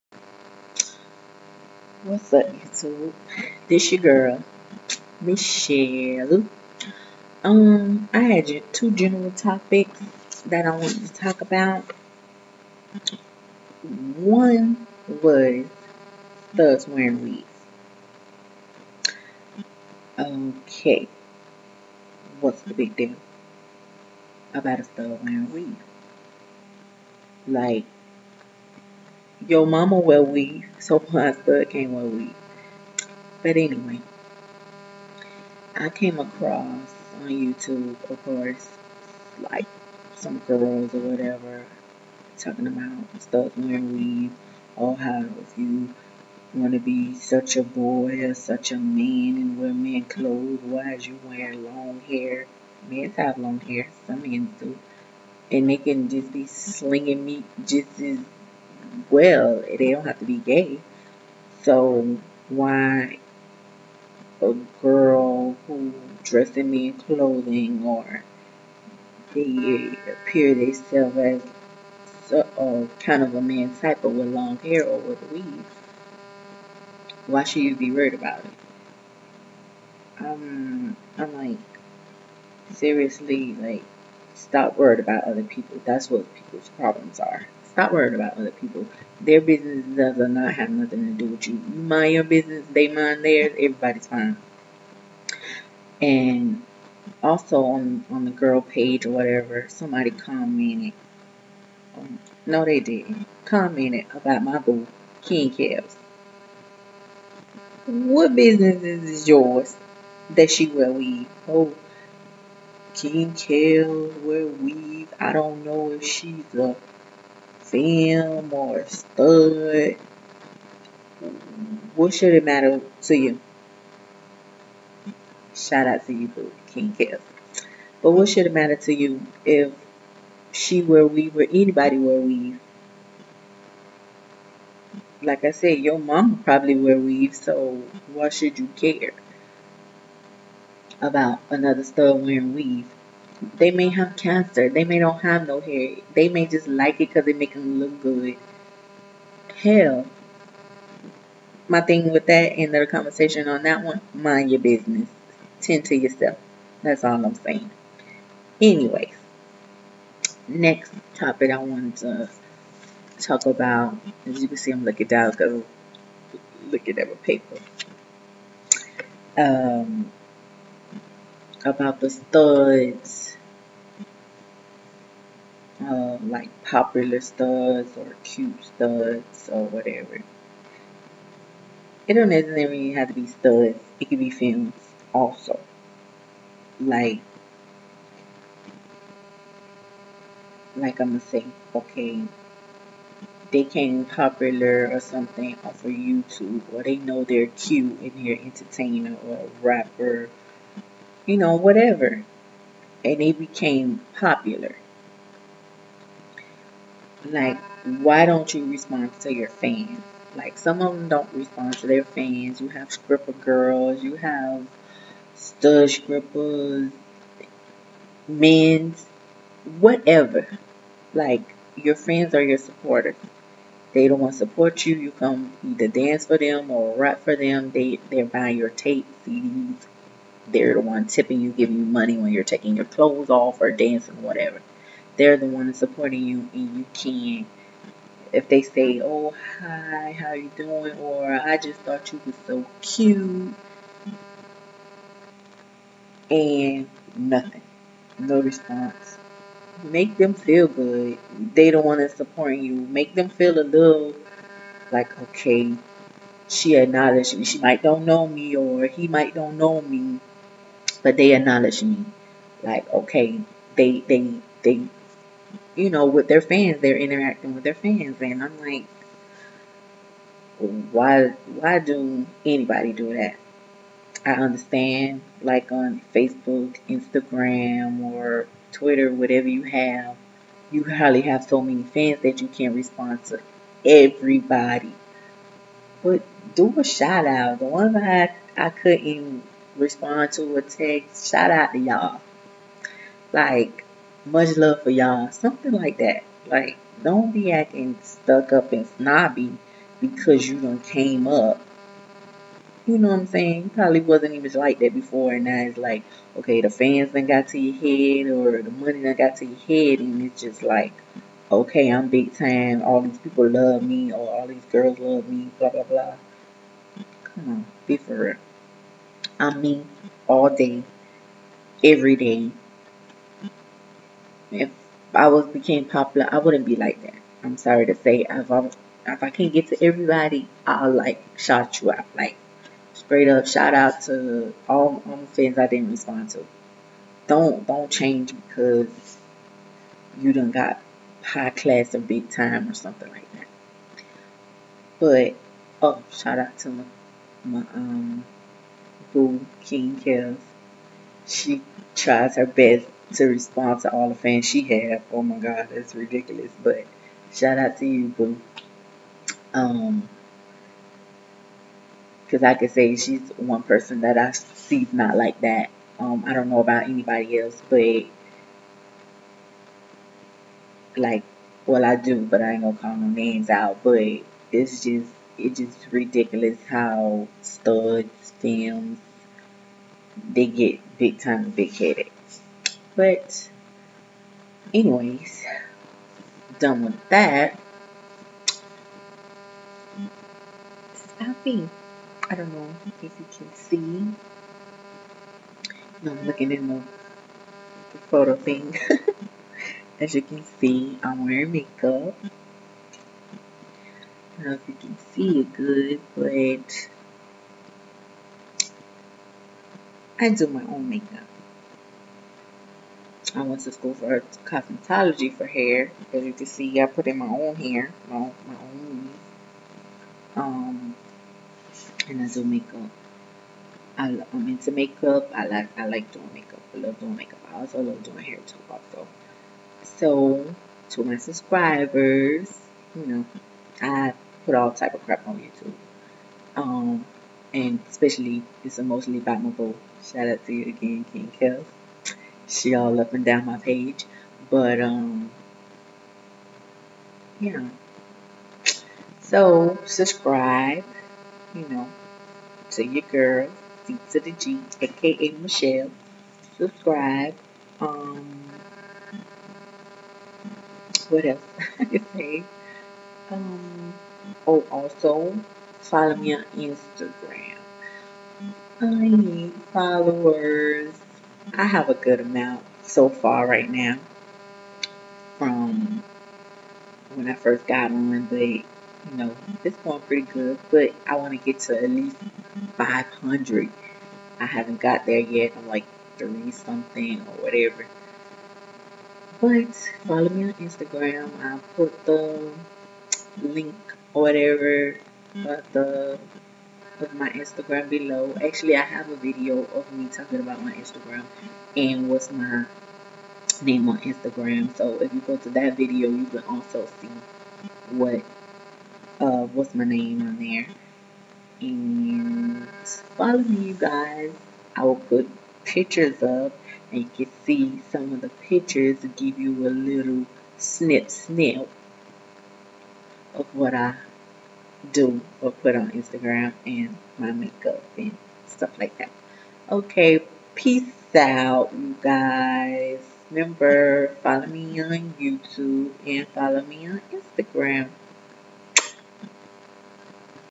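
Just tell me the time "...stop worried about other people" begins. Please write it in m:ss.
1:24.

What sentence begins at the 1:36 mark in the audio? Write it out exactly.
And also on on the girl page or whatever, somebody commented.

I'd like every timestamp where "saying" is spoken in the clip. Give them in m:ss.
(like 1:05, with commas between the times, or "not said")
2:37, 5:03.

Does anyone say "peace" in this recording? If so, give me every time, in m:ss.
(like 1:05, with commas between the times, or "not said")
8:50.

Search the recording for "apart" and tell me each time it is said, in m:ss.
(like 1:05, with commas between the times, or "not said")
not said.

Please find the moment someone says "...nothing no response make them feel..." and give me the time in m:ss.
4:07.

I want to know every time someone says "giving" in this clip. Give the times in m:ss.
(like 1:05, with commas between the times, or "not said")
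3:51.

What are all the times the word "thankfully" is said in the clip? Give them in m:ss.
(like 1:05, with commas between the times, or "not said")
not said.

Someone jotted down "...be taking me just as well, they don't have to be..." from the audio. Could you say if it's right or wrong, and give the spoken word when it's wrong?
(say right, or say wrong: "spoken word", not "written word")
wrong: "slinging", not "taking".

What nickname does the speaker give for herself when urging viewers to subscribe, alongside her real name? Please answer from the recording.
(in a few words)
C to the G.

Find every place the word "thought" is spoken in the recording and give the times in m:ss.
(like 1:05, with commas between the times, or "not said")
4:01.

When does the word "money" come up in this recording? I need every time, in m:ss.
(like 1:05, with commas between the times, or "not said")
3:51, 5:08.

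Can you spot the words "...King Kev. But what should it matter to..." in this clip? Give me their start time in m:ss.
2:06.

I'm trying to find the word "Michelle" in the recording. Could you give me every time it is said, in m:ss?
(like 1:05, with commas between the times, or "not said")
0:05, 7:35.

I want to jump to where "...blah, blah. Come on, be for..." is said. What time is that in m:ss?
5:15.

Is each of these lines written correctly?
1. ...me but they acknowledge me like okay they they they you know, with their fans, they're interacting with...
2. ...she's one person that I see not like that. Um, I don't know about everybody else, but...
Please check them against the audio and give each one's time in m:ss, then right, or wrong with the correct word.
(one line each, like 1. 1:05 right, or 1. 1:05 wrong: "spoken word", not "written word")
1. 4:19 right
2. 6:02 wrong: "anybody", not "everybody".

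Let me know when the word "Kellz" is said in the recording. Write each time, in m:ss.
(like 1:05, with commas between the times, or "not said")
1:45, 1:53, 7:21.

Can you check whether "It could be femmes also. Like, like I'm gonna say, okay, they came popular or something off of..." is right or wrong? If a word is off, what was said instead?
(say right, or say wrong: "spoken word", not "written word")
right.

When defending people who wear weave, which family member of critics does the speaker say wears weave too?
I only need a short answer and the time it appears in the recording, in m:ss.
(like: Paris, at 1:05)
Mom, at 2:15.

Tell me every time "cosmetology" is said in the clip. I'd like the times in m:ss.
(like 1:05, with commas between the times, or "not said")
6:54.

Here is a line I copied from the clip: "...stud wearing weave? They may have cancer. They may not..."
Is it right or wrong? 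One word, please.
right.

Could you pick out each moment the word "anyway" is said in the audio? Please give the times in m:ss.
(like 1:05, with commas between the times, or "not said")
0:33, 2:38, 6:24.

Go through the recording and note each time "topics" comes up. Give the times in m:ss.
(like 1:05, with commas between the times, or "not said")
0:09, 2:41.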